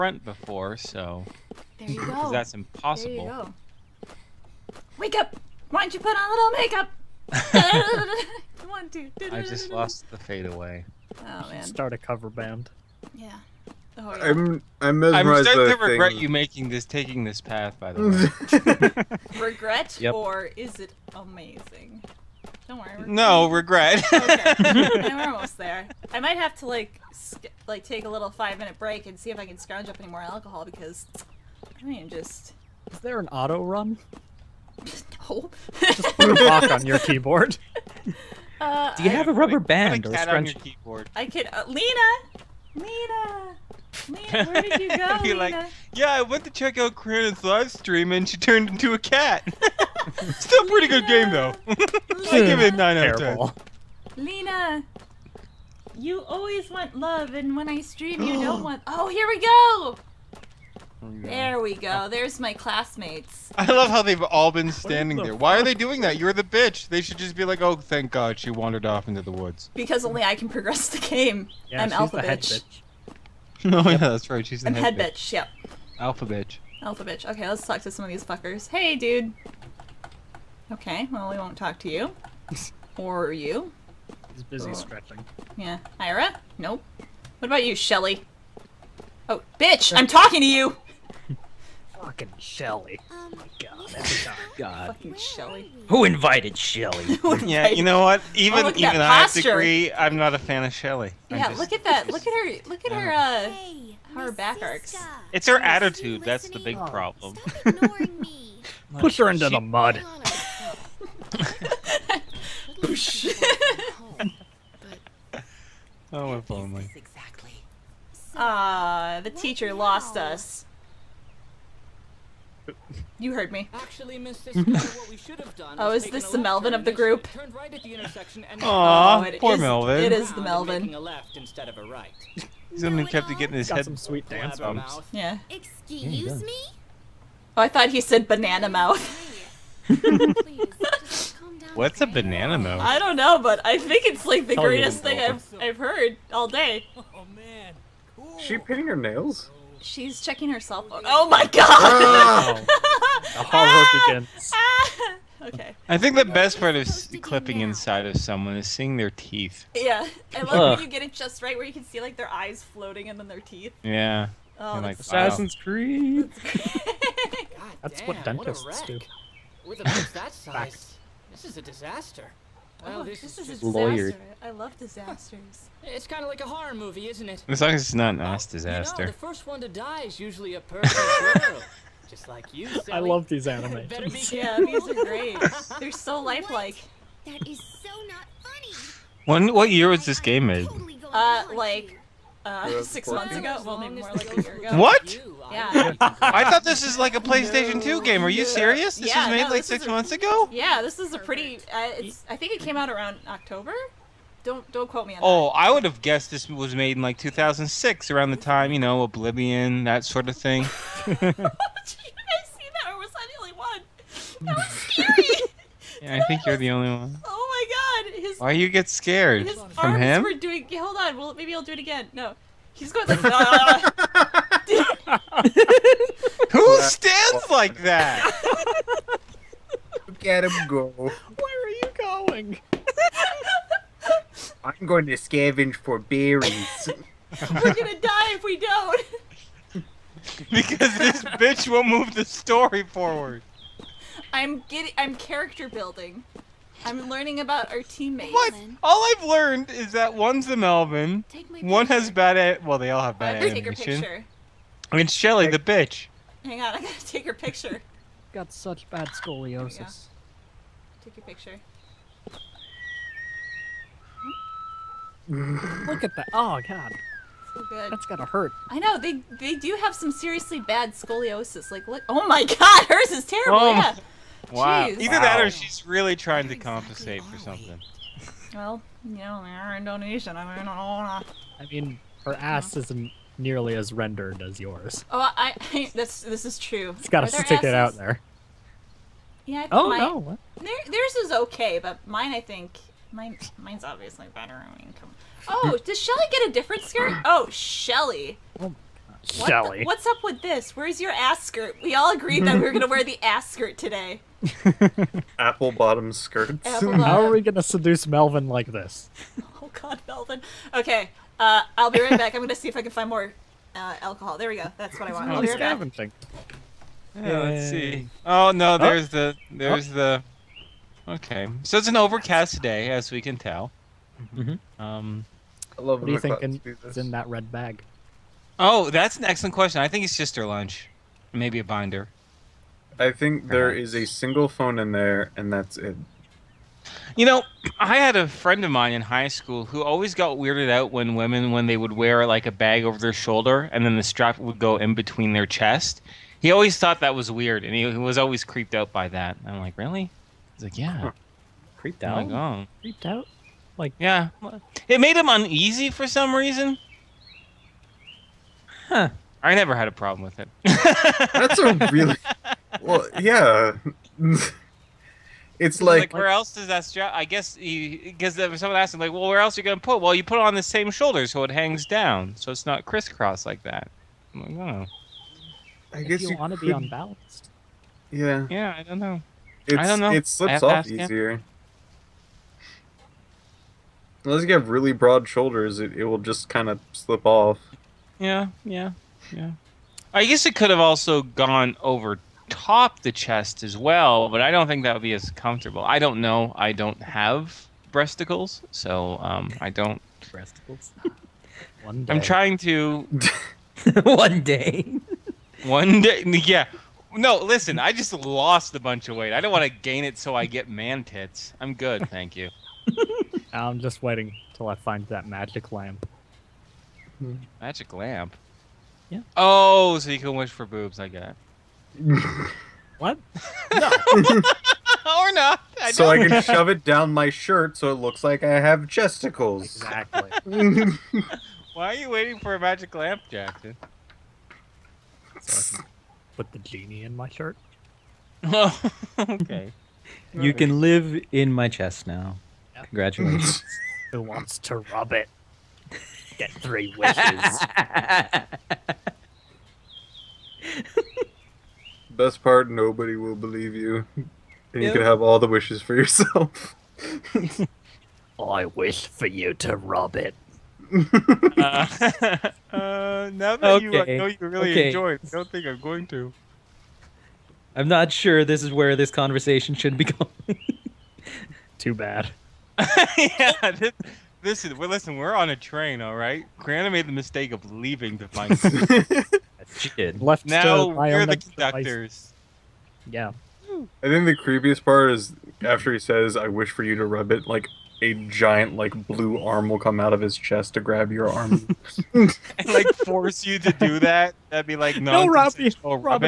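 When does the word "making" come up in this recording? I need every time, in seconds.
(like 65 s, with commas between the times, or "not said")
16 s.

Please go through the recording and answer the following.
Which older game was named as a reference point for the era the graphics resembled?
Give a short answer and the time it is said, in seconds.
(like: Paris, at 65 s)
Oblivion, at 209 s.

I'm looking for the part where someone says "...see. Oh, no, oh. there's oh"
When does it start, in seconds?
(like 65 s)
317 s.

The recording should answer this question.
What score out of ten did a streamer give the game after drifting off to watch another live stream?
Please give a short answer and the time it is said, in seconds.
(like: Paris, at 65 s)
9, at 52 s.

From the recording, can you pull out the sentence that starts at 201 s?
Uh, it's, I think it came out around October.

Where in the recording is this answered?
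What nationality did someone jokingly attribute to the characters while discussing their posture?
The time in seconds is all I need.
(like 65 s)
279 s.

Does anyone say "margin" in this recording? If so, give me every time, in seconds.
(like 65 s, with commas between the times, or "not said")
not said.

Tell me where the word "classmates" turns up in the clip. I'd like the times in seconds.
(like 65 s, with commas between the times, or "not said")
62 s.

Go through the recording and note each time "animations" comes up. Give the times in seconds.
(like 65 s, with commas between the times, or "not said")
183 s, 253 s.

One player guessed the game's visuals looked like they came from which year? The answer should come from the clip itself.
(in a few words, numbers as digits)
2006.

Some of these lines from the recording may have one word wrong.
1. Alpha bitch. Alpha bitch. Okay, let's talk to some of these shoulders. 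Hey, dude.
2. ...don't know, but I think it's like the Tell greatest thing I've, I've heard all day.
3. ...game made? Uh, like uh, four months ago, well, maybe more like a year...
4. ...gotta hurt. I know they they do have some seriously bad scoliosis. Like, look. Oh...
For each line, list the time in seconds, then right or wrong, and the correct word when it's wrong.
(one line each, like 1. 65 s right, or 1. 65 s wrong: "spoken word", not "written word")
1. 75 s wrong: "fuckers", not "shoulders"
2. 142 s right
3. 190 s wrong: "six", not "four"
4. 268 s right.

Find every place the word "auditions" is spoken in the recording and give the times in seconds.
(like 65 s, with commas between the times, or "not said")
not said.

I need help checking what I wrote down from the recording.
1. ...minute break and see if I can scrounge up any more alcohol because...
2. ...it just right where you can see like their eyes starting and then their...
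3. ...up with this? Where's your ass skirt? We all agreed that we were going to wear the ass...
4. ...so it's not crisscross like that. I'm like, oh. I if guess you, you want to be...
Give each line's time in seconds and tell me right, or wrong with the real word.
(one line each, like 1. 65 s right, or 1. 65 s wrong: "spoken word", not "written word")
1. 28 s right
2. 161 s wrong: "floating", not "starting"
3. 300 s right
4. 372 s right.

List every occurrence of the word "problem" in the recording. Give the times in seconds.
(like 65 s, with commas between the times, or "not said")
106 s, 359 s.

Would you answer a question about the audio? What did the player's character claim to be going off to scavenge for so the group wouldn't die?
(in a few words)
berries.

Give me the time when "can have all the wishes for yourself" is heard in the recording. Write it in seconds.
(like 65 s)
454 s.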